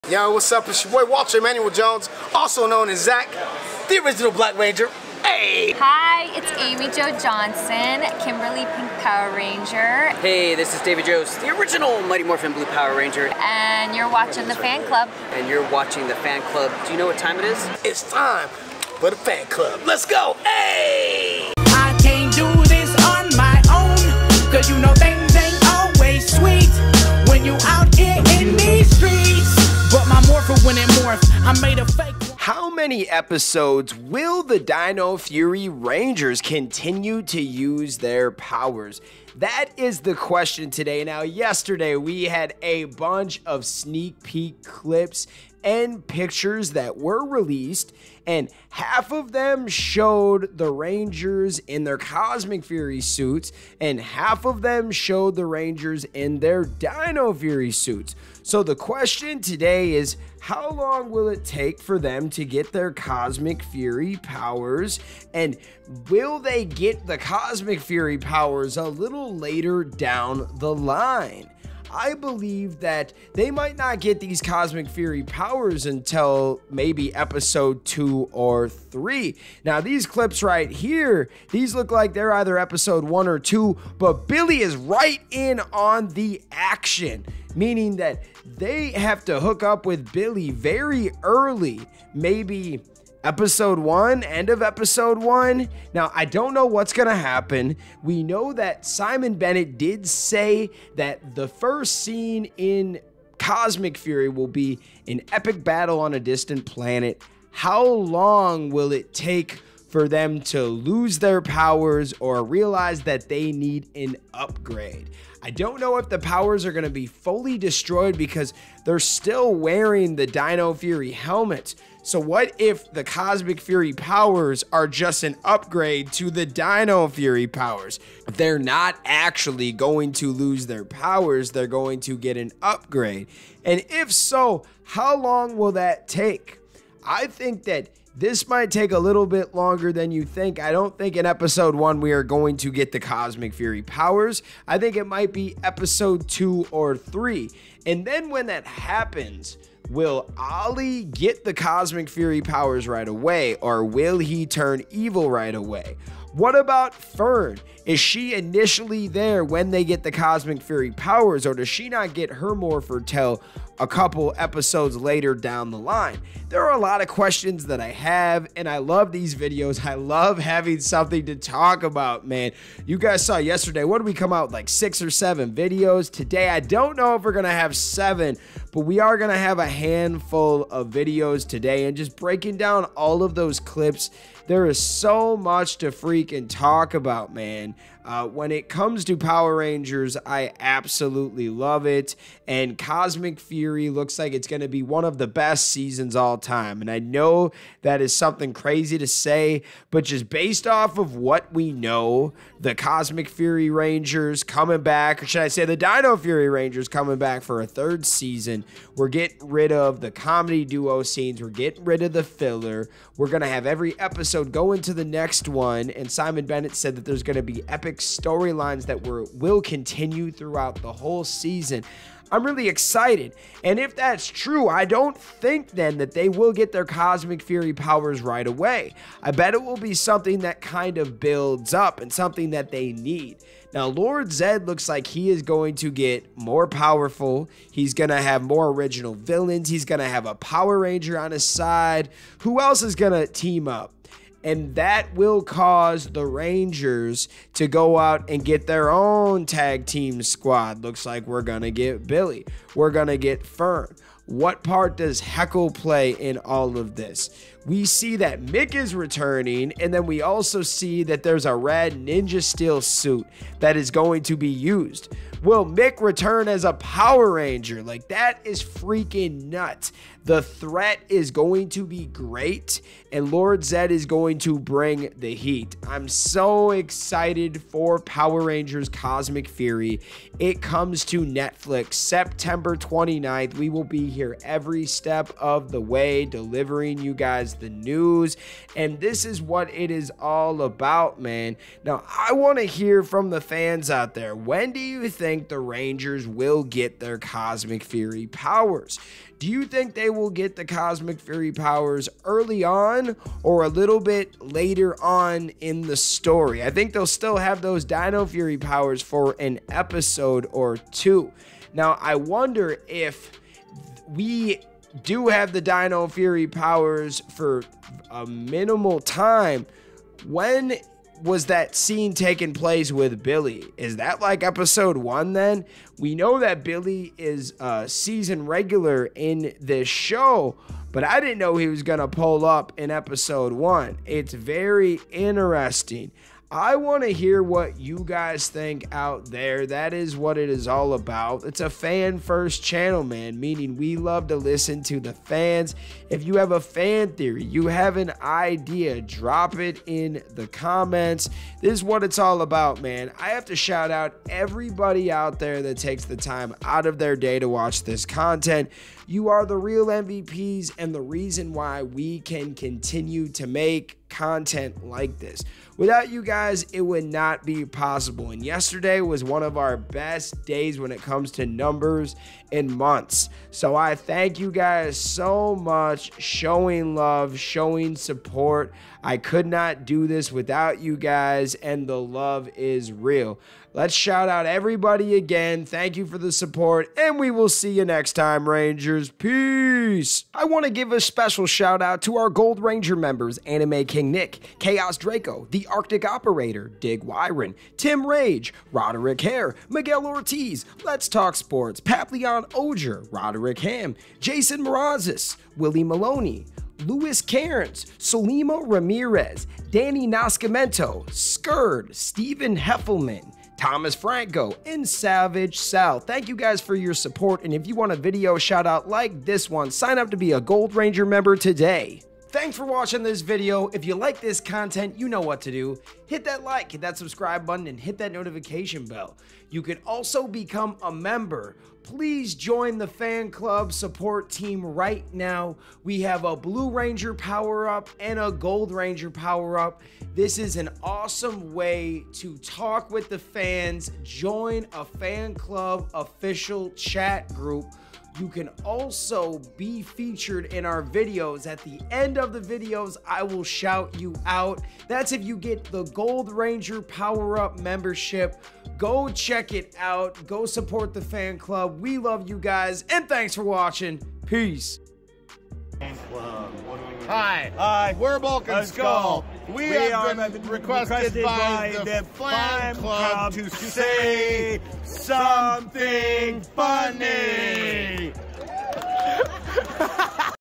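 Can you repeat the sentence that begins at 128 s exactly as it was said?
They're not actually going to lose their powers, they're going to get an upgrade.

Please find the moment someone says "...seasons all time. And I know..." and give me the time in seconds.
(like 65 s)
195 s.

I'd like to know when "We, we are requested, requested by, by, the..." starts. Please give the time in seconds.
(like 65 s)
469 s.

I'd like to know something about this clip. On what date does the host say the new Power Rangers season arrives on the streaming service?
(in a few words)
September 29th.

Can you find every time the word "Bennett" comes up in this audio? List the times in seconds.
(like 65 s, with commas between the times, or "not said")
99 s, 216 s.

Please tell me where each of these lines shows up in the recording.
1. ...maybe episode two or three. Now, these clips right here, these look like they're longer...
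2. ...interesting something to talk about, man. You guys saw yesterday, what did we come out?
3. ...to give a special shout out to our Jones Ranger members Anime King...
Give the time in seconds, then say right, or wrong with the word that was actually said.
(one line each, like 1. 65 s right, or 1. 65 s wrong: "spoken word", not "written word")
1. 76 s wrong: "either", not "longer"
2. 170 s wrong: "having", not "interesting"
3. 390 s wrong: "Gold", not "Jones".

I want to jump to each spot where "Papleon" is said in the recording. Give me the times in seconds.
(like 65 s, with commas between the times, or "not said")
401 s.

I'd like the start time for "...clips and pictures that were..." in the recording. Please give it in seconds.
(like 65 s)
44 s.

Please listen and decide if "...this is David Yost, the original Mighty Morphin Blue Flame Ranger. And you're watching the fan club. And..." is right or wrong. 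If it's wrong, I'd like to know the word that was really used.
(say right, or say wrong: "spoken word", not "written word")
wrong: "Power", not "Flame".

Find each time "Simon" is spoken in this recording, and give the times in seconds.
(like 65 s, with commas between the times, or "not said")
98 s, 216 s.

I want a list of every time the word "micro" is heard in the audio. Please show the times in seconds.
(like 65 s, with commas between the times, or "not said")
not said.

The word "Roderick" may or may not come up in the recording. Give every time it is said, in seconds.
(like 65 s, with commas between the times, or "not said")
398 s, 403 s.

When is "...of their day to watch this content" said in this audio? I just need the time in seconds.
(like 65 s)
356 s.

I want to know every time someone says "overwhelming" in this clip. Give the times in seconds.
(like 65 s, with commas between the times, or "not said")
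not said.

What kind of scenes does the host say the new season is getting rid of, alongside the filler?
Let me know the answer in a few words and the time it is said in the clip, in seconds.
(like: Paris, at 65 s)
comedy duo scenes, at 210 s.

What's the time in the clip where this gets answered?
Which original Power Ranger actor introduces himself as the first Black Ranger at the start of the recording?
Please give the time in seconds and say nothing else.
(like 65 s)
1 s.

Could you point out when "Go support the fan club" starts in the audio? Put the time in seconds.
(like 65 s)
460 s.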